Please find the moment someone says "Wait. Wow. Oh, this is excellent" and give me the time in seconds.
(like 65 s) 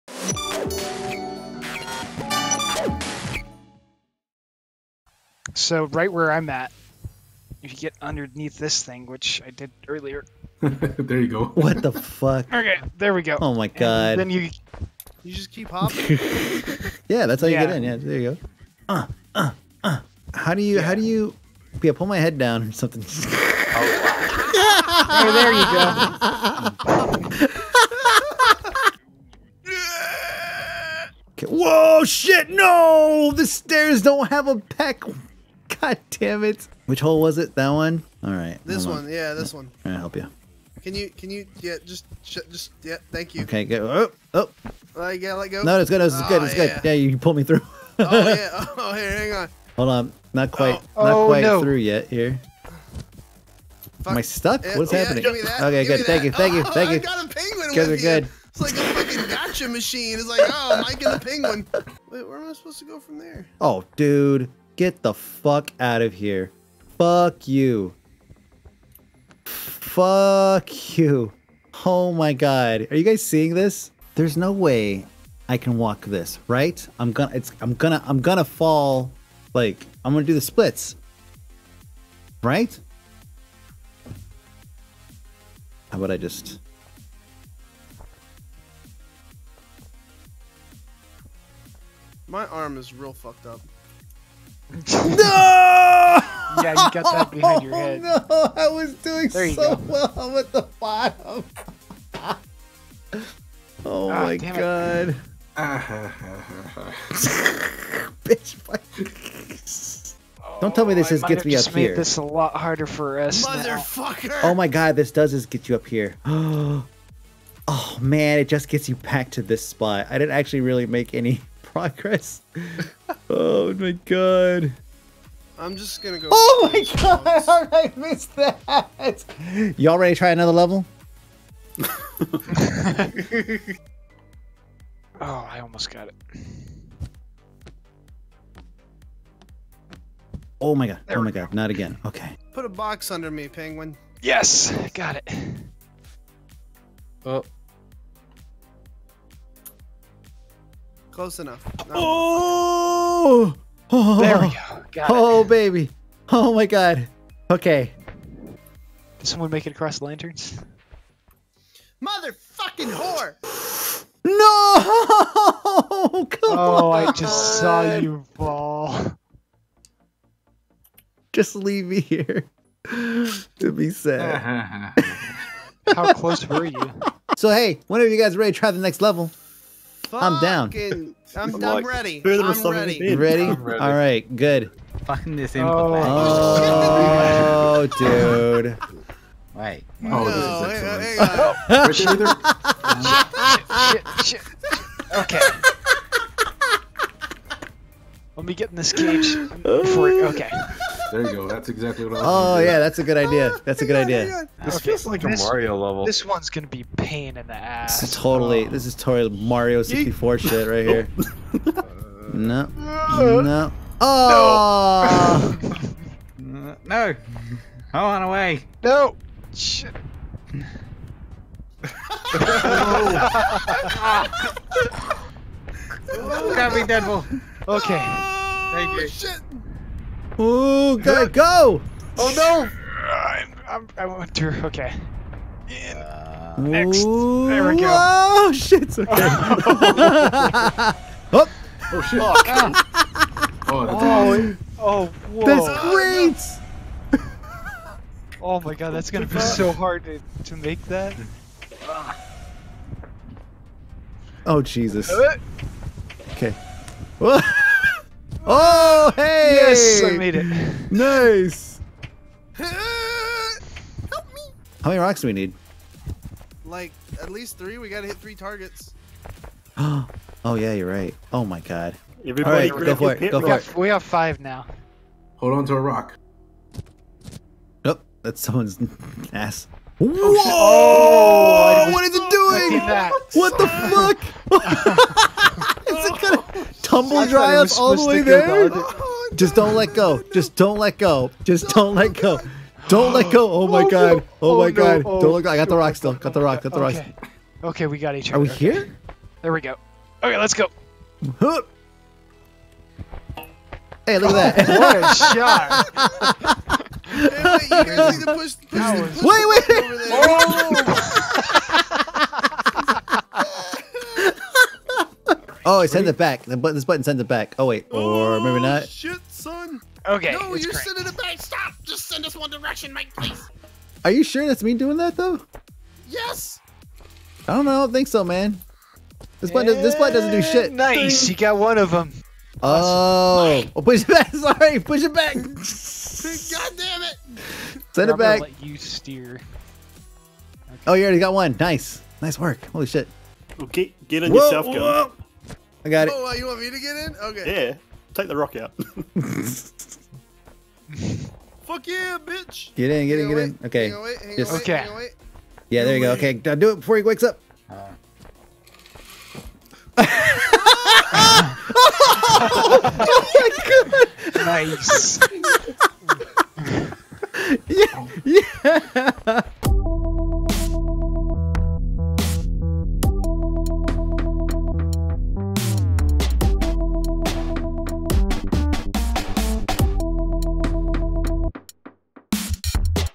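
189 s.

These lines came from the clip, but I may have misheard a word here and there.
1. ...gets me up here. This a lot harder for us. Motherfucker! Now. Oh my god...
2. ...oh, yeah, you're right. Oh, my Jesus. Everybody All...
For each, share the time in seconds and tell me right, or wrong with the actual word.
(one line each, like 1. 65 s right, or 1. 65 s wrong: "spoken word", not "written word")
1. 111 s right
2. 269 s wrong: "God", not "Jesus".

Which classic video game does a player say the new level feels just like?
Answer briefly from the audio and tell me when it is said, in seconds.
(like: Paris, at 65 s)
Mario 64, at 209 s.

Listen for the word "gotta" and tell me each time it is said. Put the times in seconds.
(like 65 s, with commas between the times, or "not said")
45 s, 267 s.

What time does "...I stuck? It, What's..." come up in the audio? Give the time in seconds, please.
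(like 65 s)
54 s.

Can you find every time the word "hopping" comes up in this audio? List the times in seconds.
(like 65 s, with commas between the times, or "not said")
15 s.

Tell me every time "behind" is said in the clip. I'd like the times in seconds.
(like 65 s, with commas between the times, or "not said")
97 s.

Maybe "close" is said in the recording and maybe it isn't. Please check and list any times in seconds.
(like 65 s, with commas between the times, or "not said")
151 s, 176 s.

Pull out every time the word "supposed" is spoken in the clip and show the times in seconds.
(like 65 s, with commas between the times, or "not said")
62 s.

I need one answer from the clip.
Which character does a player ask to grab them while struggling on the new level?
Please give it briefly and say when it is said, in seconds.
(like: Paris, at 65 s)
Deadpool, at 226 s.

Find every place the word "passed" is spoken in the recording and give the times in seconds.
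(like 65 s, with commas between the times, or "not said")
not said.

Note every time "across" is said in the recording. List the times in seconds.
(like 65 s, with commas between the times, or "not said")
159 s.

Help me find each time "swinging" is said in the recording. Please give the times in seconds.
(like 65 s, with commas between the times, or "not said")
not said.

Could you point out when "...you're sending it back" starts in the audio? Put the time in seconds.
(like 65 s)
320 s.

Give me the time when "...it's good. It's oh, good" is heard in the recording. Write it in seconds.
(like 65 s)
45 s.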